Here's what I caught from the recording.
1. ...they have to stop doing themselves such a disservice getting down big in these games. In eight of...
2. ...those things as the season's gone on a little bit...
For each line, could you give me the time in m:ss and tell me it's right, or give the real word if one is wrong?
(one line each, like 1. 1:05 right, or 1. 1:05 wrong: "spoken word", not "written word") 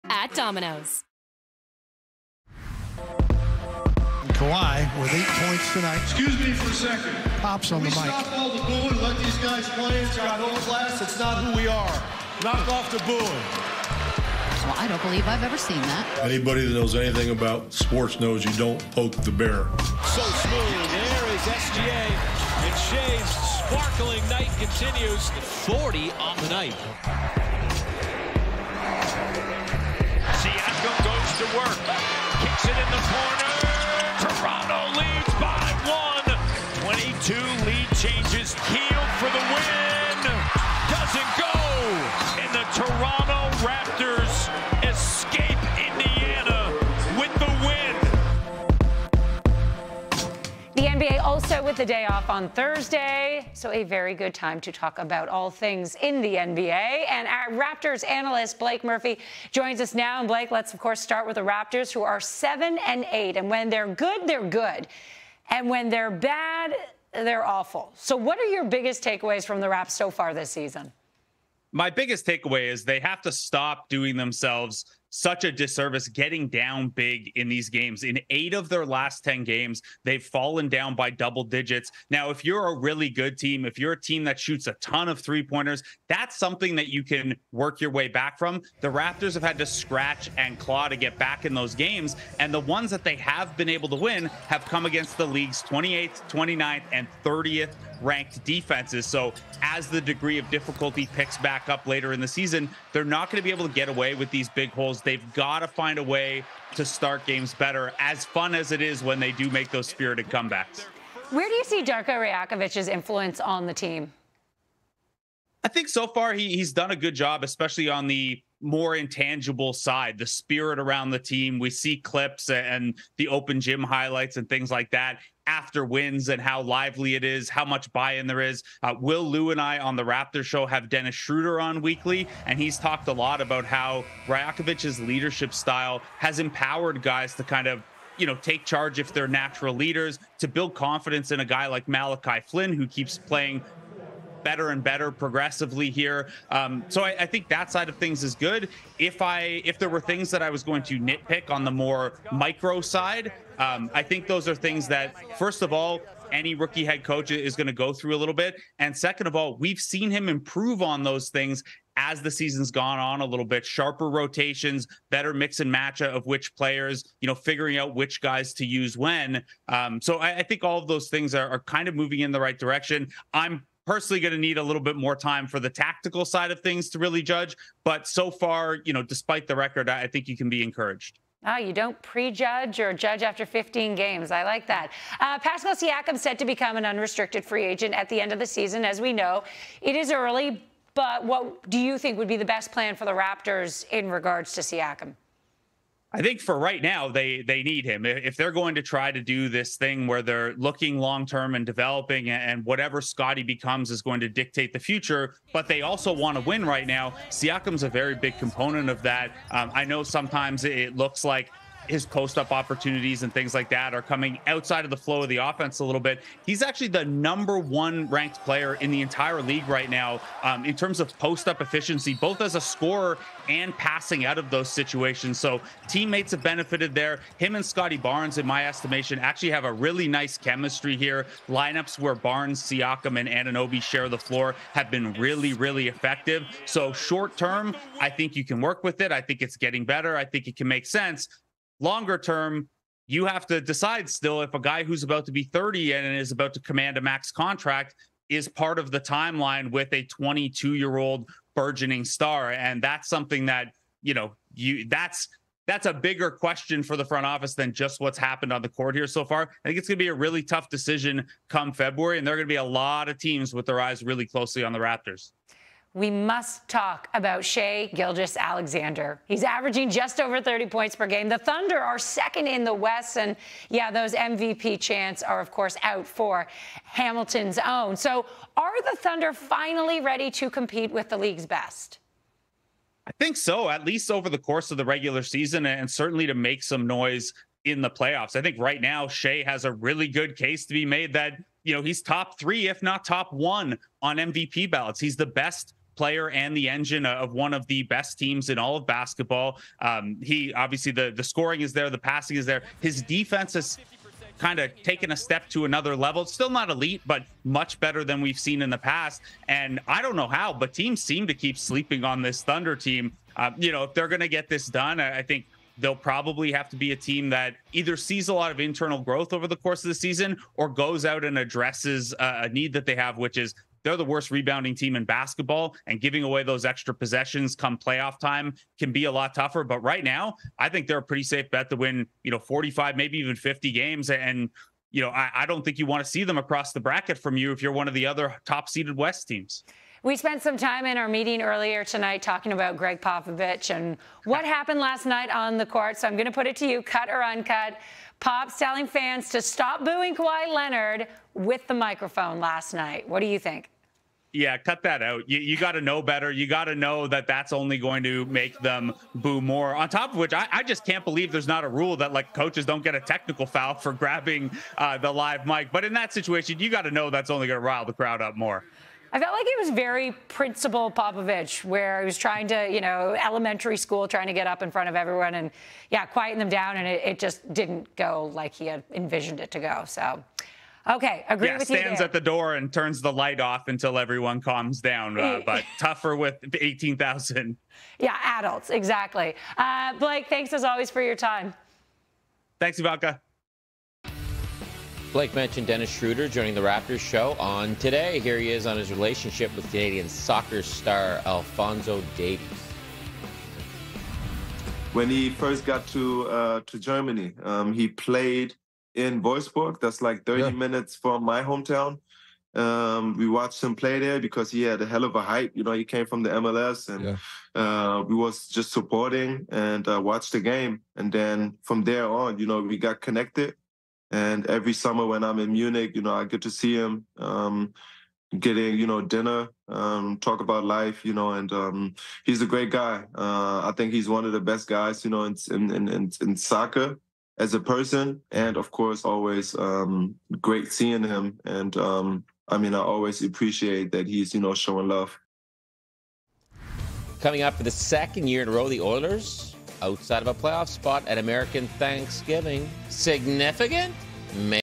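1. 1:12 right
2. 2:41 right.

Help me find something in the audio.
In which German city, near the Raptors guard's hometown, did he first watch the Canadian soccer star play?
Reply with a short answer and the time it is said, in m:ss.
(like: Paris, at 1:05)
Wolfsburg, at 6:49.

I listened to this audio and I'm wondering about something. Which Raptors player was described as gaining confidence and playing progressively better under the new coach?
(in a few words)
Malachi Flynn.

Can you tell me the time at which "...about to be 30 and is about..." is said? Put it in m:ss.
4:05.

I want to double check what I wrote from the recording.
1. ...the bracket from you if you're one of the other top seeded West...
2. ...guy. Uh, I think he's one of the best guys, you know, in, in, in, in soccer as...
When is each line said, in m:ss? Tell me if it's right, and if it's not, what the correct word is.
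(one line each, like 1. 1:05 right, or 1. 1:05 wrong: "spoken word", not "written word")
1. 5:36 right
2. 7:12 right.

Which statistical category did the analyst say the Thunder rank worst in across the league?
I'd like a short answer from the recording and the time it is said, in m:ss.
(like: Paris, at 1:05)
Rebounding, at 5:24.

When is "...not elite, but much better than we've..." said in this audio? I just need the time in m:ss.
5:06.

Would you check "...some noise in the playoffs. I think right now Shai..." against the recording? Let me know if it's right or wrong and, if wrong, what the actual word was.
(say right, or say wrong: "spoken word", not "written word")
right.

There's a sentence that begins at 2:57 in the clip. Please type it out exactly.
But so far, you know, despite the record, I think you can be encouraged.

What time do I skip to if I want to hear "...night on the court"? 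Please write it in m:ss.
5:45.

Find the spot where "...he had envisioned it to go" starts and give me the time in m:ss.
6:18.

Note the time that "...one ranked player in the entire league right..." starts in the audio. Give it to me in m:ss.
3:37.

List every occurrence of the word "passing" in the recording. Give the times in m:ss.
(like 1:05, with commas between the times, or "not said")
3:43, 5:01.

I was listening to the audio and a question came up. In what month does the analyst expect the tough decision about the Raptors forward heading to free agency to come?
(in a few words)
February.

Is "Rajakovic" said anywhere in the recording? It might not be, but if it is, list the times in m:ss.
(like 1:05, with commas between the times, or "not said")
1:52, 2:14.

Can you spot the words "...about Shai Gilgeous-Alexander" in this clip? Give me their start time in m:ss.
4:27.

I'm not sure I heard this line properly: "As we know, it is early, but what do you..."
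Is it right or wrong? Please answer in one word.
right.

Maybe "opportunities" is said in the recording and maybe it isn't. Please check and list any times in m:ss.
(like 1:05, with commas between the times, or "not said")
3:32.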